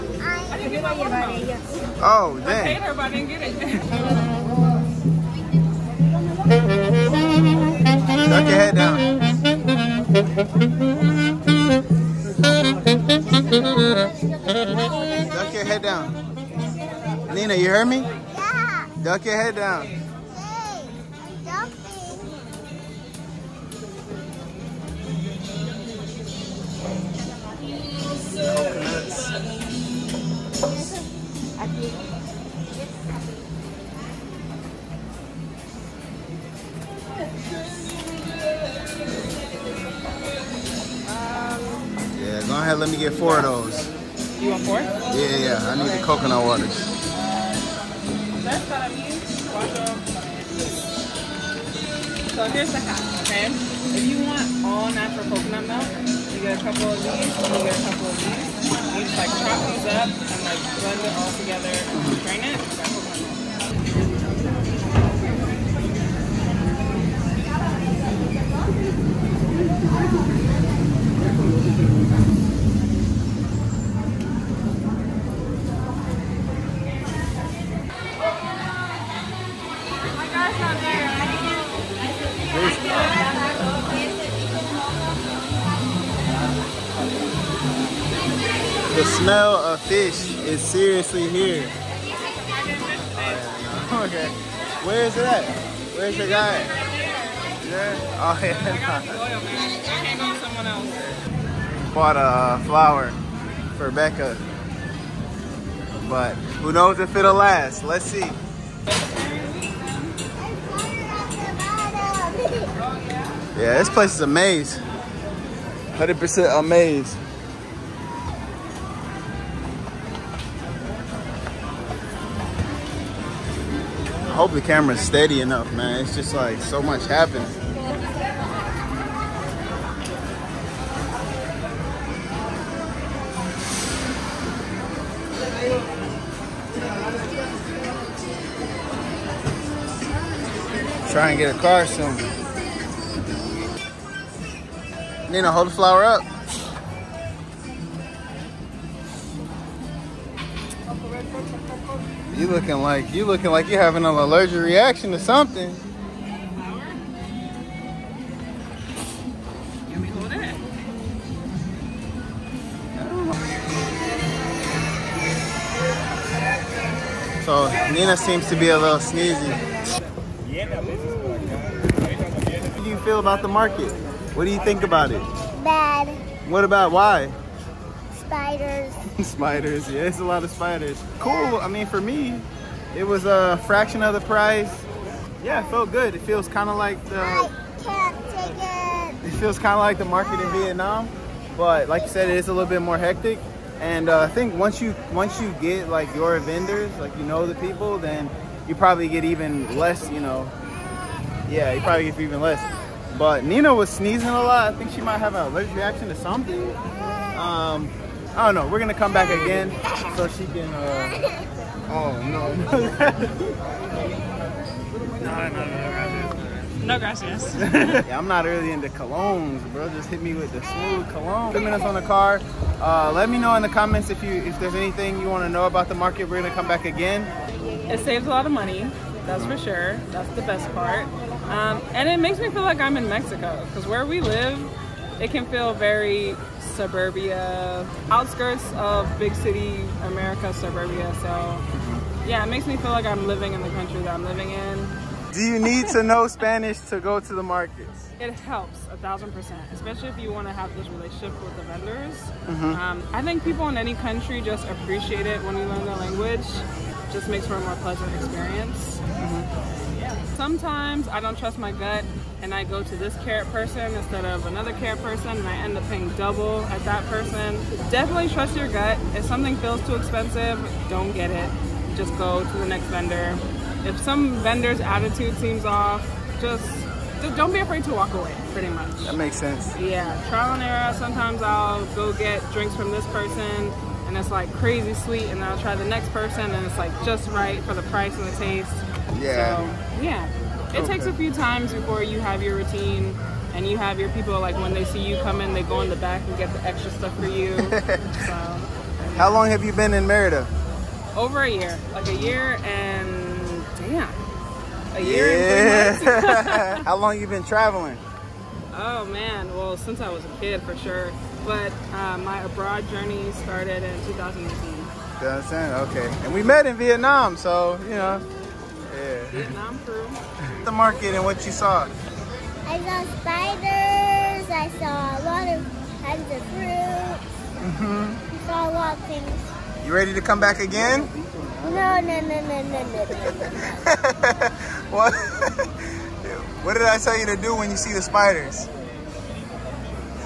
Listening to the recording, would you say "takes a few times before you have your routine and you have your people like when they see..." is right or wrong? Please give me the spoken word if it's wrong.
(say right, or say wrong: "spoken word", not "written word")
right.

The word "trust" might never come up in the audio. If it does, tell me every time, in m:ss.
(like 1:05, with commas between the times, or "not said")
4:21, 4:28.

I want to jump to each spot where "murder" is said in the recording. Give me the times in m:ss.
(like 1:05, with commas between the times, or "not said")
not said.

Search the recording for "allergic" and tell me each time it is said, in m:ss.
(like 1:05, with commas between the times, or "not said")
2:34, 3:25.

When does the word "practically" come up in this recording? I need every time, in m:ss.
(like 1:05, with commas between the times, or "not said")
not said.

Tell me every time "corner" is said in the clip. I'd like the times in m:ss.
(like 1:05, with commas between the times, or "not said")
not said.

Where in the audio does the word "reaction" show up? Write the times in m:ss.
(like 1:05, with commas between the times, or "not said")
2:34, 3:25.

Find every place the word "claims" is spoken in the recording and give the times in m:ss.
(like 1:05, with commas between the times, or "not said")
not said.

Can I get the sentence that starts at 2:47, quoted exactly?
So Nina seems to be a little sneezy.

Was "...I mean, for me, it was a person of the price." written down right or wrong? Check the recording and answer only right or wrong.
wrong.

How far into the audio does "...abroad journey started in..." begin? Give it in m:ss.
5:12.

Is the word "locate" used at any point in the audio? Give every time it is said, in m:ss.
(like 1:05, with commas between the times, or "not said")
not said.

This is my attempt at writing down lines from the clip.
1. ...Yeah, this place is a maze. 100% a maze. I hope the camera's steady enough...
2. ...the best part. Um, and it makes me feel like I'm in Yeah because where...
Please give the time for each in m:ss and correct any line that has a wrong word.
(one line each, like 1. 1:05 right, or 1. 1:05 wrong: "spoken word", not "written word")
1. 1:53 right
2. 3:50 wrong: "Mexico", not "Yeah".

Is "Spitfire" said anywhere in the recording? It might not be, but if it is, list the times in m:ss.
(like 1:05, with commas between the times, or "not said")
not said.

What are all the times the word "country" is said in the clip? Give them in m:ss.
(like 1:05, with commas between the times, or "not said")
4:03, 4:14.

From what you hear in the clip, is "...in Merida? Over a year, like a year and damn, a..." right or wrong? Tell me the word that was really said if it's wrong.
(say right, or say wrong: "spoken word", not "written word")
right.